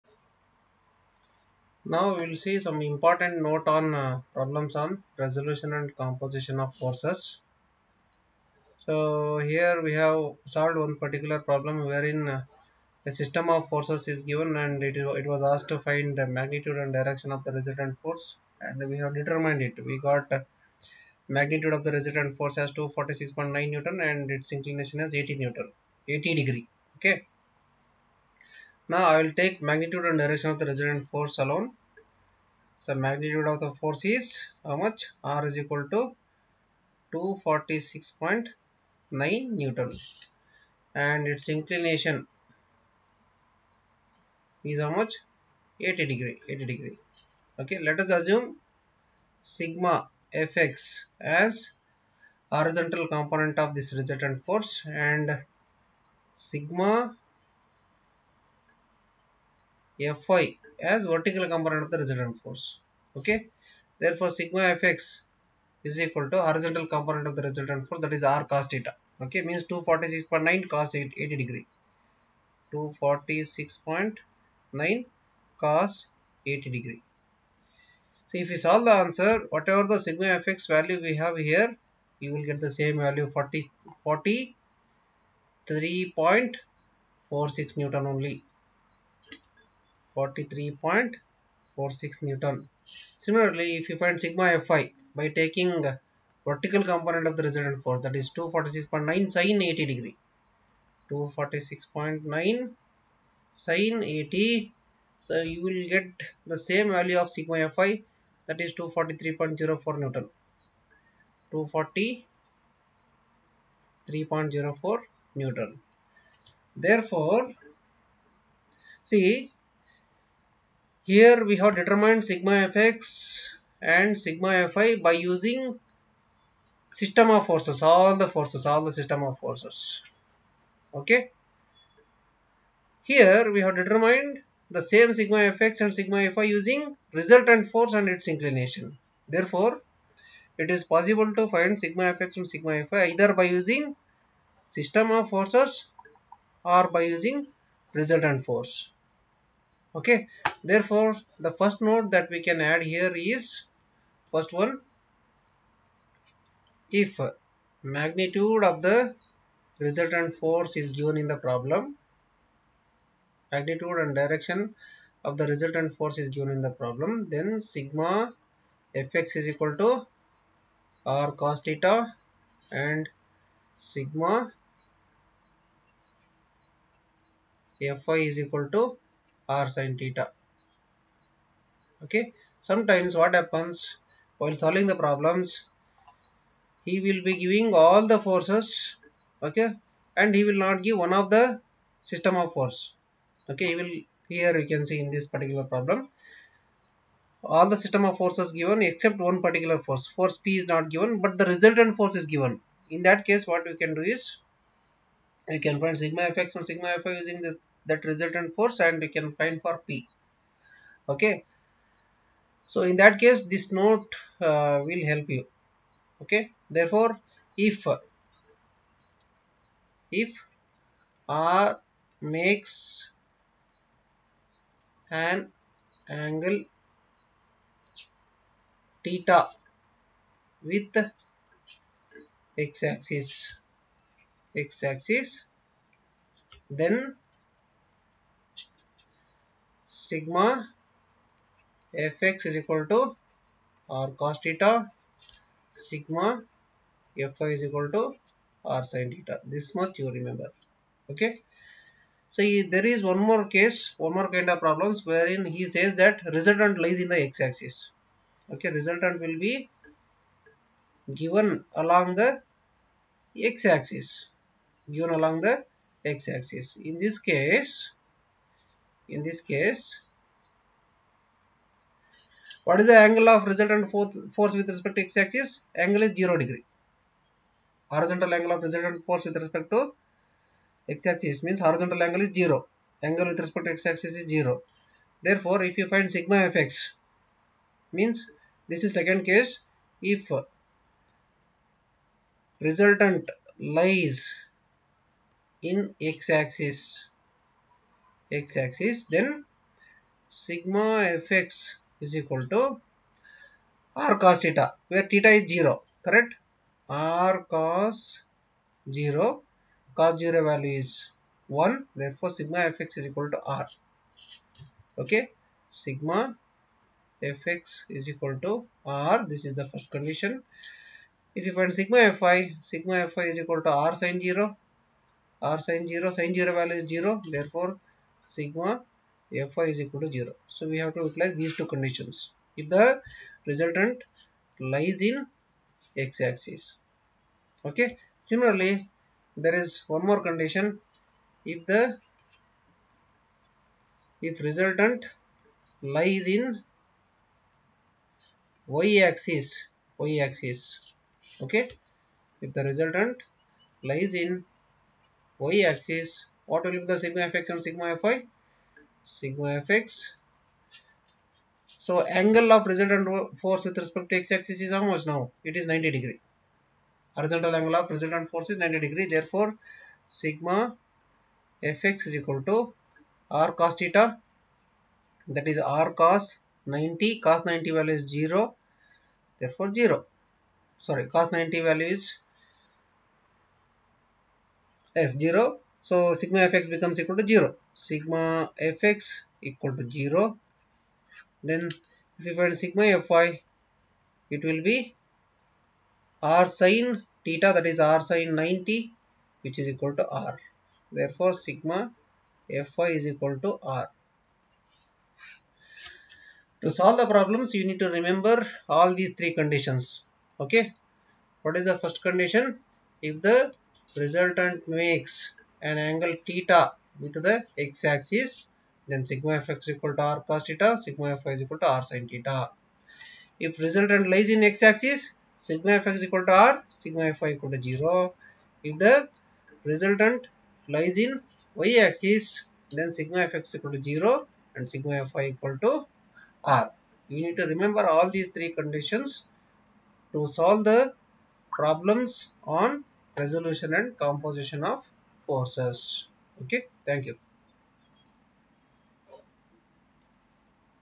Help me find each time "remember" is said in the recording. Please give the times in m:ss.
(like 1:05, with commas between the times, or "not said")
4:10, 6:47, 7:17.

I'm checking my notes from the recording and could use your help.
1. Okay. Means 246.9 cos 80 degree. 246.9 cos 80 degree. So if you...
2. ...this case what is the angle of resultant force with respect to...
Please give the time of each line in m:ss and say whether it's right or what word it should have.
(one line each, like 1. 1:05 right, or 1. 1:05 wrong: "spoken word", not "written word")
1. 1:09 right
2. 4:29 right.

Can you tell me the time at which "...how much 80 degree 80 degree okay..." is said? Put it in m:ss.
0:44.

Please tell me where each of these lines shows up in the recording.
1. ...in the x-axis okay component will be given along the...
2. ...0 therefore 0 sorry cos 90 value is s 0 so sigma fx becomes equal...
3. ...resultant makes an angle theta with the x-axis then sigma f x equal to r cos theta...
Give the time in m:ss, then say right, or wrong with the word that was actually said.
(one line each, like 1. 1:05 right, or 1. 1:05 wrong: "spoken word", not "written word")
1. 4:17 wrong: "resultant", not "component"
2. 6:18 right
3. 6:53 right.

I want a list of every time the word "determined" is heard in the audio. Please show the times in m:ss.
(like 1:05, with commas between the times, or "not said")
0:19, 2:01, 2:13.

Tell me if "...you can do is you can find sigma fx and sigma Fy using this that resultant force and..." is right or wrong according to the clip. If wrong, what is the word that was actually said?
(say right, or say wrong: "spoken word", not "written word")
right.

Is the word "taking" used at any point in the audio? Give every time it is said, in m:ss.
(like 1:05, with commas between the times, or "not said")
1:35.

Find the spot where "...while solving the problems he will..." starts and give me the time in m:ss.
3:04.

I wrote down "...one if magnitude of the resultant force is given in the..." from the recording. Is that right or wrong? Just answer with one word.
right.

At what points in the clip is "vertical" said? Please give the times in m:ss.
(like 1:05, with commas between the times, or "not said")
1:01, 1:36.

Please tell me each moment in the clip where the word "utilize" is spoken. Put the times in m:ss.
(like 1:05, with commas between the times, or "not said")
5:31.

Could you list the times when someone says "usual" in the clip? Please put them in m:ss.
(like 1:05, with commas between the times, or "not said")
not said.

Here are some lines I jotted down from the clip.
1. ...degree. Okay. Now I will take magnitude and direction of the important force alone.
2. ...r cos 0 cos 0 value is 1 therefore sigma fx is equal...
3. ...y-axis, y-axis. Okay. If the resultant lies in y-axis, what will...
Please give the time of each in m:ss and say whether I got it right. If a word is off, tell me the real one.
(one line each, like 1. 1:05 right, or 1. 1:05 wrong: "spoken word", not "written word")
1. 0:26 wrong: "resultant", not "important"
2. 5:06 right
3. 5:48 right.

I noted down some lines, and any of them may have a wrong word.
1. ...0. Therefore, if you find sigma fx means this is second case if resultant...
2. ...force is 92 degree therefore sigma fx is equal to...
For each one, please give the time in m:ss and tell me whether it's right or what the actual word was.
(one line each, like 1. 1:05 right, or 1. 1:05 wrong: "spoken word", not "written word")
1. 4:44 right
2. 6:08 wrong: "90", not "92".